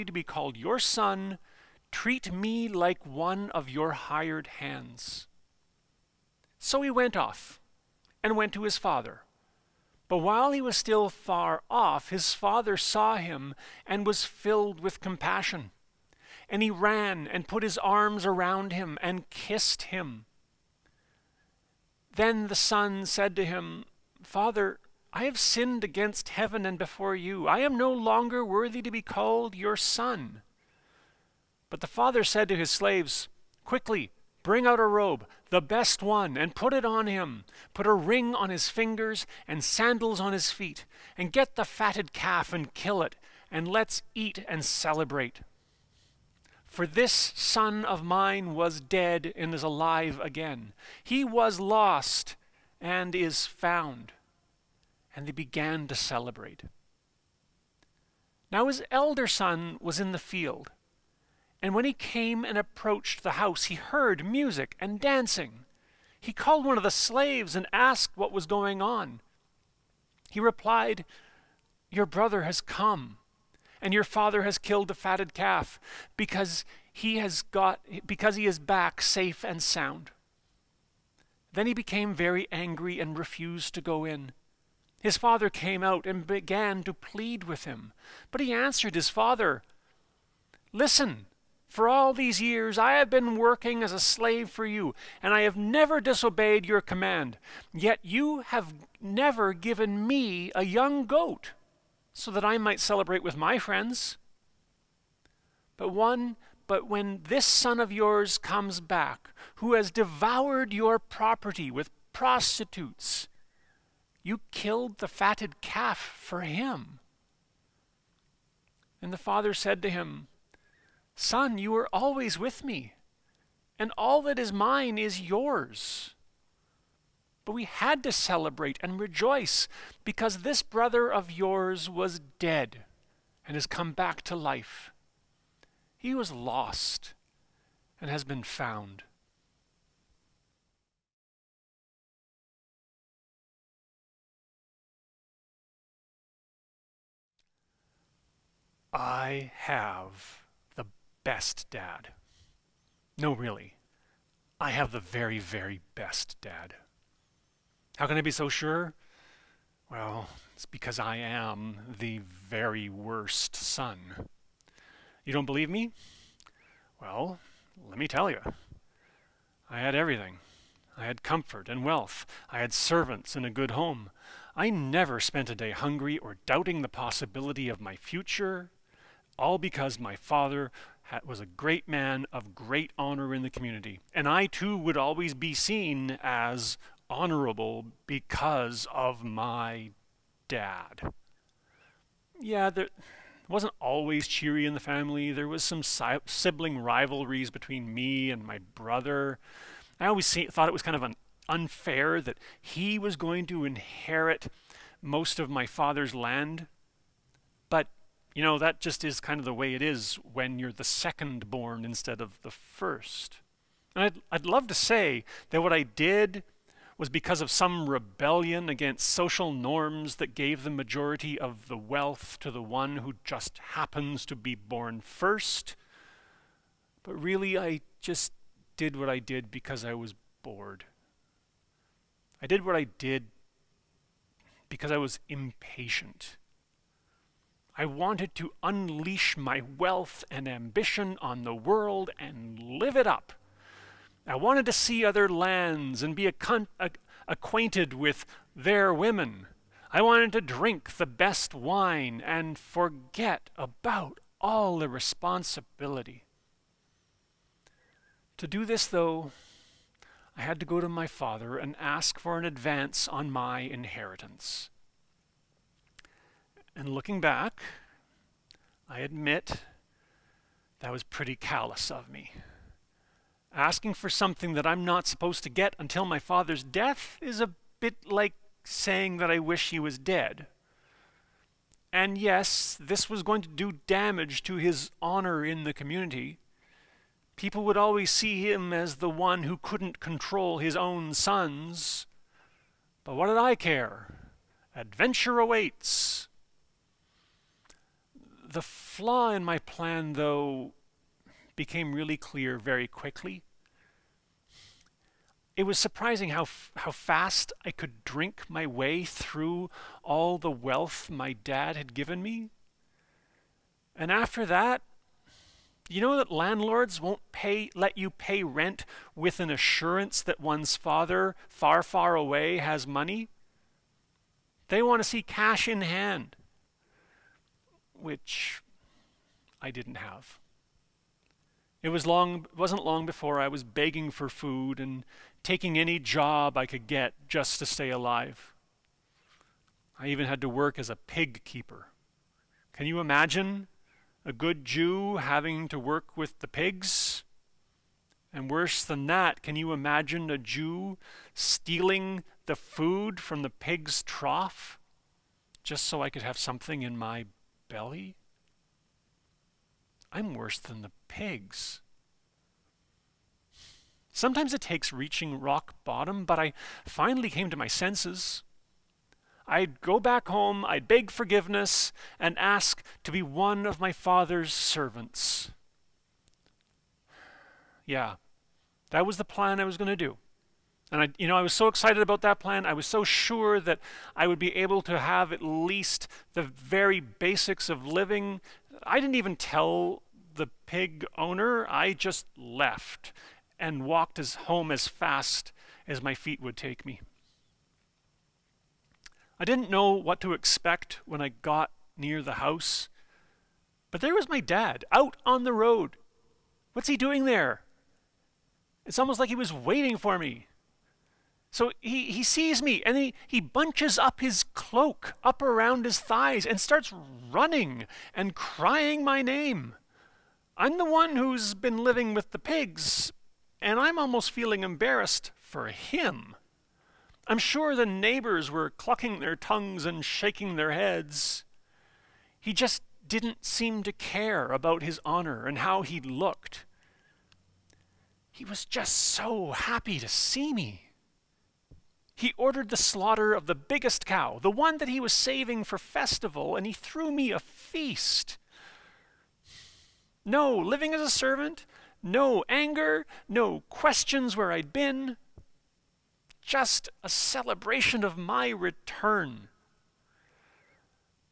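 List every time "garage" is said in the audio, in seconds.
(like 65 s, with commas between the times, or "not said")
not said.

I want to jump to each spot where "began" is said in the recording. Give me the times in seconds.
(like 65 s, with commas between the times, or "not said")
55 s, 86 s.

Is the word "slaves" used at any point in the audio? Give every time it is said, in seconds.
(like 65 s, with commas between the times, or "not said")
32 s, 66 s, 93 s.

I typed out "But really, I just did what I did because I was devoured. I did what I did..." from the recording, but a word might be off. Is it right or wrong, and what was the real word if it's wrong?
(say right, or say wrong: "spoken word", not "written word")
wrong: "bored", not "devoured".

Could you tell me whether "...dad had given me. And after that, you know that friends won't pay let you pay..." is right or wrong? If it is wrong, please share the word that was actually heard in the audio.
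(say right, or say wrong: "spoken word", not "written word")
wrong: "landlords", not "friends".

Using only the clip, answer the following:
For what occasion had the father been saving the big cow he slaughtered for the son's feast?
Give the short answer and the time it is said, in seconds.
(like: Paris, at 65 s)
Festival, at 445 s.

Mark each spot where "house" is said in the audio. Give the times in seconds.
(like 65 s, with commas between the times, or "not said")
63 s, 402 s.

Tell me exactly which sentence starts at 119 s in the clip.
And the father said to him, Son, you are always with me, and all that is mine is yours.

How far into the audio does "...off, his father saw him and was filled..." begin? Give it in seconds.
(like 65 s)
11 s.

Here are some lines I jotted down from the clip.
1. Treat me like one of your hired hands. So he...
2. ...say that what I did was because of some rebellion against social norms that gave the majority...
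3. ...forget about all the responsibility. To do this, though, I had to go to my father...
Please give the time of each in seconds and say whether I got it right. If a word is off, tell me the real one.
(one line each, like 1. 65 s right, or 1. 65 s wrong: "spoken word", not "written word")
1. 1 s right
2. 214 s right
3. 252 s right.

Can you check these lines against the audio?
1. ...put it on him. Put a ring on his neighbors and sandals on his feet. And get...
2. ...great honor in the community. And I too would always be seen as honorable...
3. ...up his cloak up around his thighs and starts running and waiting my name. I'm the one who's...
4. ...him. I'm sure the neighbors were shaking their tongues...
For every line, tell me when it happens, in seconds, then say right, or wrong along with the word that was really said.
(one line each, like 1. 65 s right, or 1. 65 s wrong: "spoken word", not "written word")
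1. 36 s wrong: "fingers", not "neighbors"
2. 182 s right
3. 413 s wrong: "crying", not "waiting"
4. 425 s wrong: "clucking", not "shaking".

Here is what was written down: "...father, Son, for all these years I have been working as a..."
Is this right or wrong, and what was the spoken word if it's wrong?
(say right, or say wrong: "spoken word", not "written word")
wrong: "Listen", not "Son".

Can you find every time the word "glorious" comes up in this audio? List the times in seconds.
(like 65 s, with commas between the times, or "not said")
not said.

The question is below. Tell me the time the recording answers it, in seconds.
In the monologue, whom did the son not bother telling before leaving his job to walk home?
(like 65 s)
390 s.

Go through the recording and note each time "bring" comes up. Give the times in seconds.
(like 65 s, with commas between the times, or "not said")
34 s.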